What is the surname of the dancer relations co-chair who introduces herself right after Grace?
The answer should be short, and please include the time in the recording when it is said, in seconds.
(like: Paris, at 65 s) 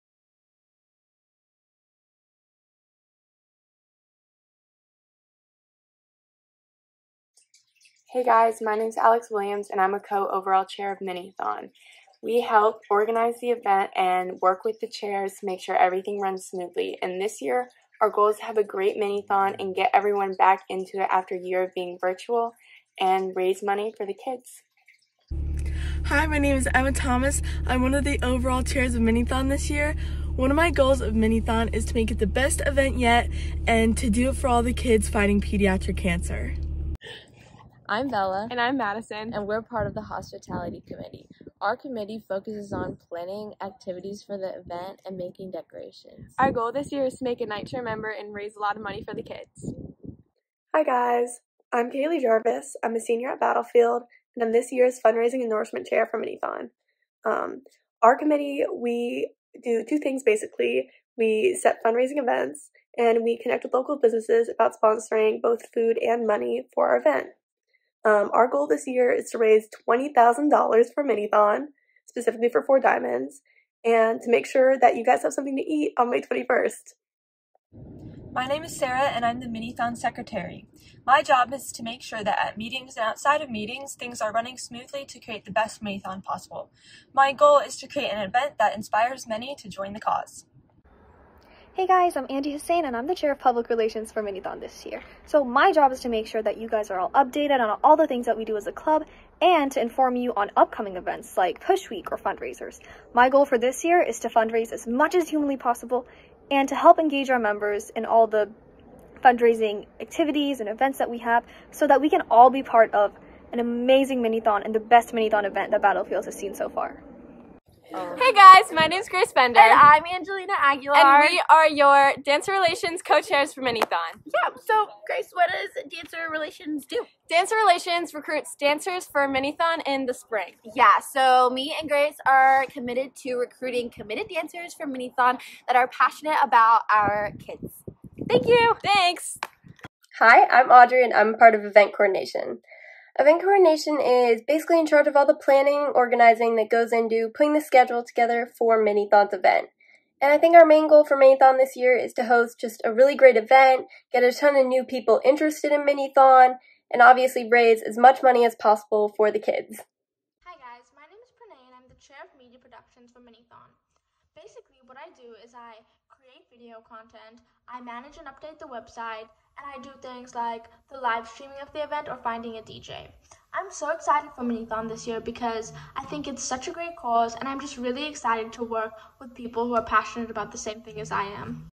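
Aguilar, at 120 s.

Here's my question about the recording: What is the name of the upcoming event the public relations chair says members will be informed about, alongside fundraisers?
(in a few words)
Push Week.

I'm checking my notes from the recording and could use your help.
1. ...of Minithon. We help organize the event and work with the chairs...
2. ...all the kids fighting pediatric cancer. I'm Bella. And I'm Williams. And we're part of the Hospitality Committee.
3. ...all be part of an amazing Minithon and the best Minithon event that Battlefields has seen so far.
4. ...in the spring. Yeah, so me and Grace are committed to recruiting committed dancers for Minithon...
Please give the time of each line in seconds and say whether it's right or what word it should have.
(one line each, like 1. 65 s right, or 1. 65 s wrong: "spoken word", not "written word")
1. 10 s right
2. 34 s wrong: "Madison", not "Williams"
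3. 112 s right
4. 129 s right.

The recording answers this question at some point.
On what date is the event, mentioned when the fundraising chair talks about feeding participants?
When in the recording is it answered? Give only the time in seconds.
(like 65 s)
76 s.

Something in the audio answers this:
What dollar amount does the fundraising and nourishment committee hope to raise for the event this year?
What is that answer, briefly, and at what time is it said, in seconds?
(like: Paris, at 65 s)
$20,000, at 69 s.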